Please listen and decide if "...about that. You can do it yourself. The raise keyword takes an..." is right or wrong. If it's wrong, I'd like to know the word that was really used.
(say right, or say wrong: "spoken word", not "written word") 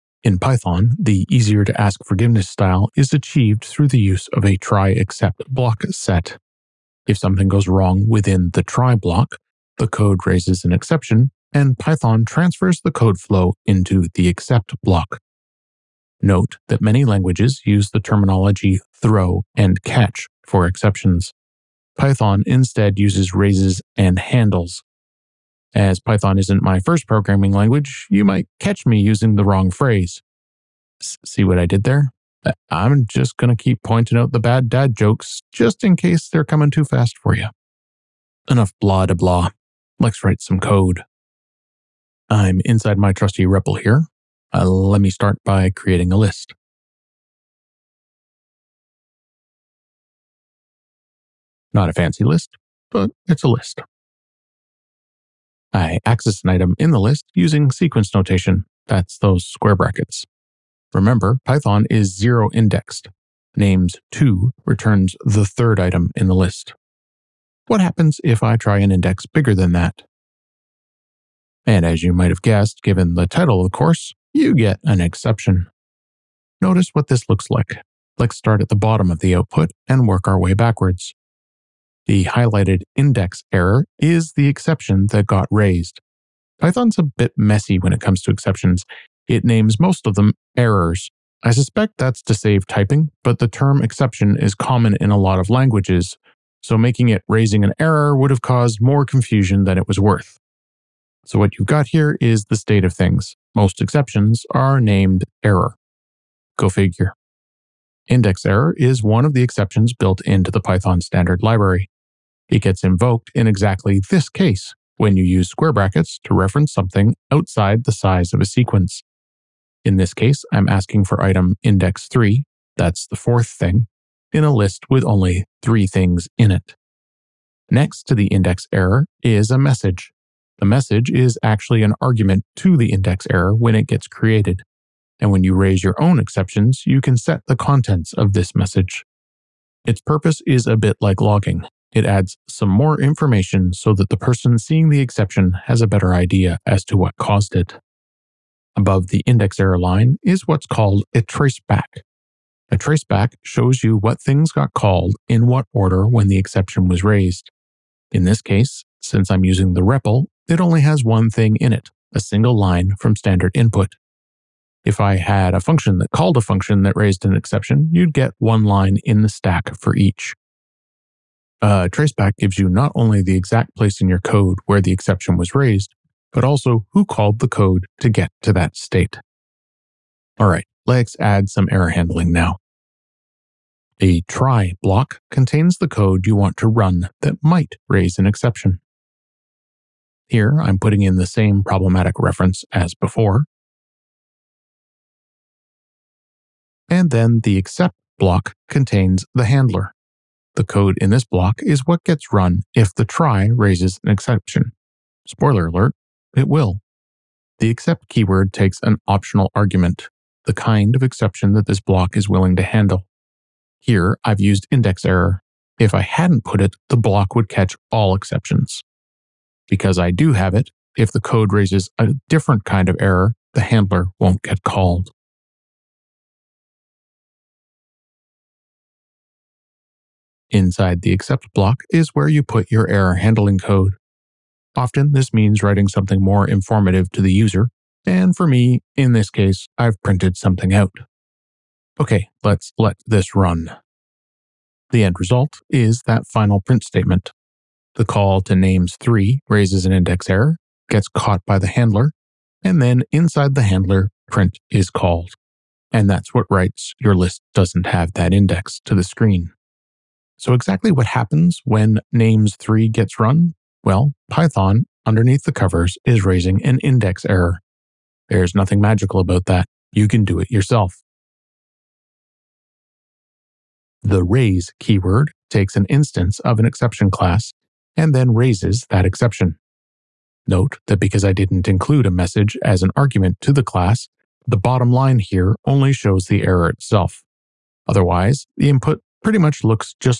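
right.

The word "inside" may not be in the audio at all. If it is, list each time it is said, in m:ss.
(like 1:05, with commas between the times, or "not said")
0:42, 3:50, 4:13.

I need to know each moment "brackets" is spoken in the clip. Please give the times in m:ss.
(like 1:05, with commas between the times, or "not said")
0:59, 1:55.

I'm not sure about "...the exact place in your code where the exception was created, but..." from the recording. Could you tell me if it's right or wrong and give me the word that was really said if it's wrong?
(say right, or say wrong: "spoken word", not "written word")
wrong: "raised", not "created".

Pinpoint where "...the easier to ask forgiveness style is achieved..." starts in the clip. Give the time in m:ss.
0:00.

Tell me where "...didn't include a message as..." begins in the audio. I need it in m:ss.
4:41.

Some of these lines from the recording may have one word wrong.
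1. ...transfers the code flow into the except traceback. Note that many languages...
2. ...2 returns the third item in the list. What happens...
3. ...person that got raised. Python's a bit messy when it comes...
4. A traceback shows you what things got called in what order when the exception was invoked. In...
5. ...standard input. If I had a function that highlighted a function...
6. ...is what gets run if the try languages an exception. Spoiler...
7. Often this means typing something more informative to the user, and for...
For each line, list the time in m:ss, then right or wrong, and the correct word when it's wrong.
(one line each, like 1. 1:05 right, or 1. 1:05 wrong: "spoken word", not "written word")
1. 0:12 wrong: "block", not "traceback"
2. 1:04 right
3. 1:24 wrong: "exception", not "person"
4. 2:32 wrong: "raised", not "invoked"
5. 2:43 wrong: "called", not "highlighted"
6. 3:21 wrong: "raises", not "languages"
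7. 3:54 wrong: "writing", not "typing".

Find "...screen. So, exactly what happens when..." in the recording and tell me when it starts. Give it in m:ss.
4:19.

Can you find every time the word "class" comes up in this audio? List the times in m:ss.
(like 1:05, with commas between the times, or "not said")
4:37, 4:43.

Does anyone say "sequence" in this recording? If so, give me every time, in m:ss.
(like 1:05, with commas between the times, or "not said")
0:57, 1:58.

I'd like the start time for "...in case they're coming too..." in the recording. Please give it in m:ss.
0:35.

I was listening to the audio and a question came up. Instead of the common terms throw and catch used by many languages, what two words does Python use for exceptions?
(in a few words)
raises and handles.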